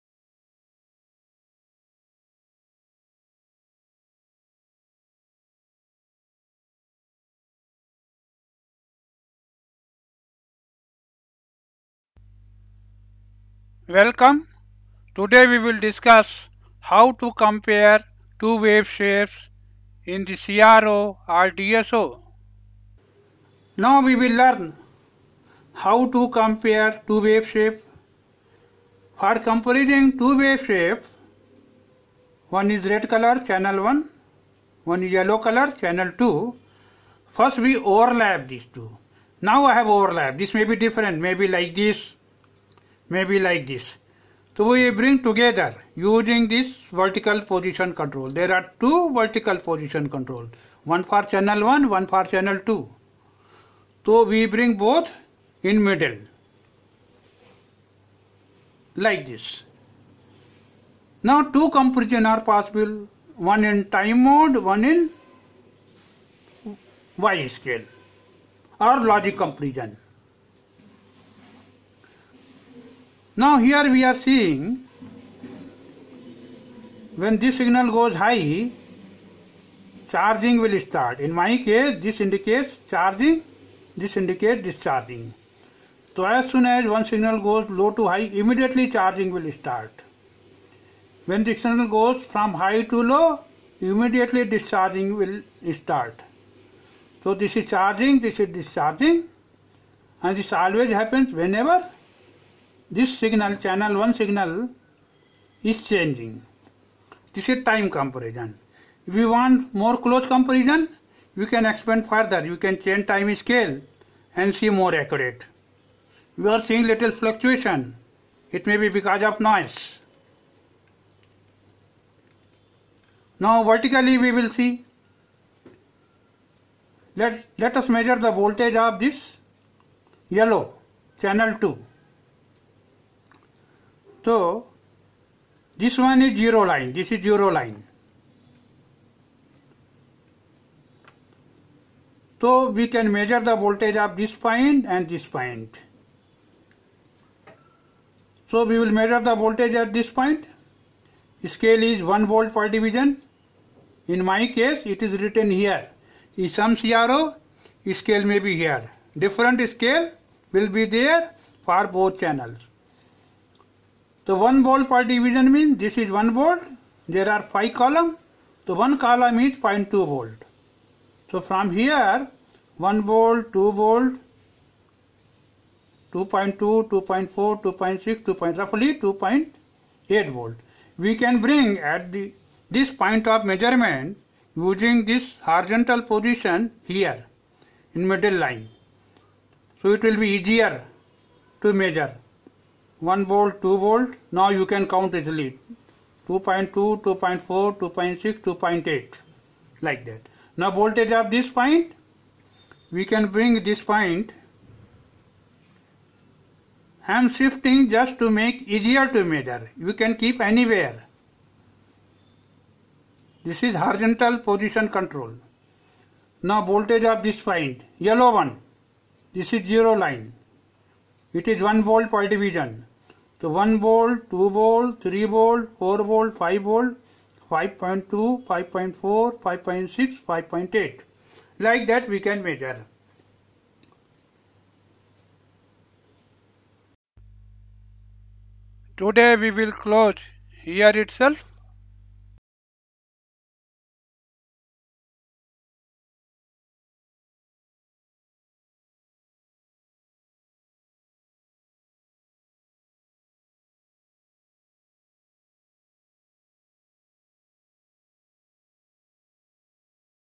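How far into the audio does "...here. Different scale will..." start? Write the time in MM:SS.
02:38.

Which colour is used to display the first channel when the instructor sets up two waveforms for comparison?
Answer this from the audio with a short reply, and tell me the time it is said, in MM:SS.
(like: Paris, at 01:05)
Red, at 00:32.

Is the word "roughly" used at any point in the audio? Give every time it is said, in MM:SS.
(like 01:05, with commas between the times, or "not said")
02:58.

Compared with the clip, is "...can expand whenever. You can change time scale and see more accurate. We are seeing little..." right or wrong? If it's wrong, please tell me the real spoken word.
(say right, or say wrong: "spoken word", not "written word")
wrong: "further", not "whenever".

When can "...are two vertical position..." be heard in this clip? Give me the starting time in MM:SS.
00:48.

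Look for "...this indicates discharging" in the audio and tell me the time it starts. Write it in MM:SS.
01:23.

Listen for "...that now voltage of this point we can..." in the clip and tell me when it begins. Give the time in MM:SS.
03:20.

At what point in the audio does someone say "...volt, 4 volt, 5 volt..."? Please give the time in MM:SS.
03:45.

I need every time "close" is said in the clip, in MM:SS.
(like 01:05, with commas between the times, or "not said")
01:49, 03:59.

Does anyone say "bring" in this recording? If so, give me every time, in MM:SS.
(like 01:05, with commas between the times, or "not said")
00:44, 00:54, 03:01, 03:23.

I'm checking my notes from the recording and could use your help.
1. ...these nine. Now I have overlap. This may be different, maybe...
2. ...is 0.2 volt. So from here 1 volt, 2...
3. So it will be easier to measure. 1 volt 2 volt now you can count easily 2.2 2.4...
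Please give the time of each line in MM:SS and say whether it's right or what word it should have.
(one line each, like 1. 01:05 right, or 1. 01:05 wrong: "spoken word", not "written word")
1. 00:38 wrong: "two", not "nine"
2. 02:49 right
3. 03:09 right.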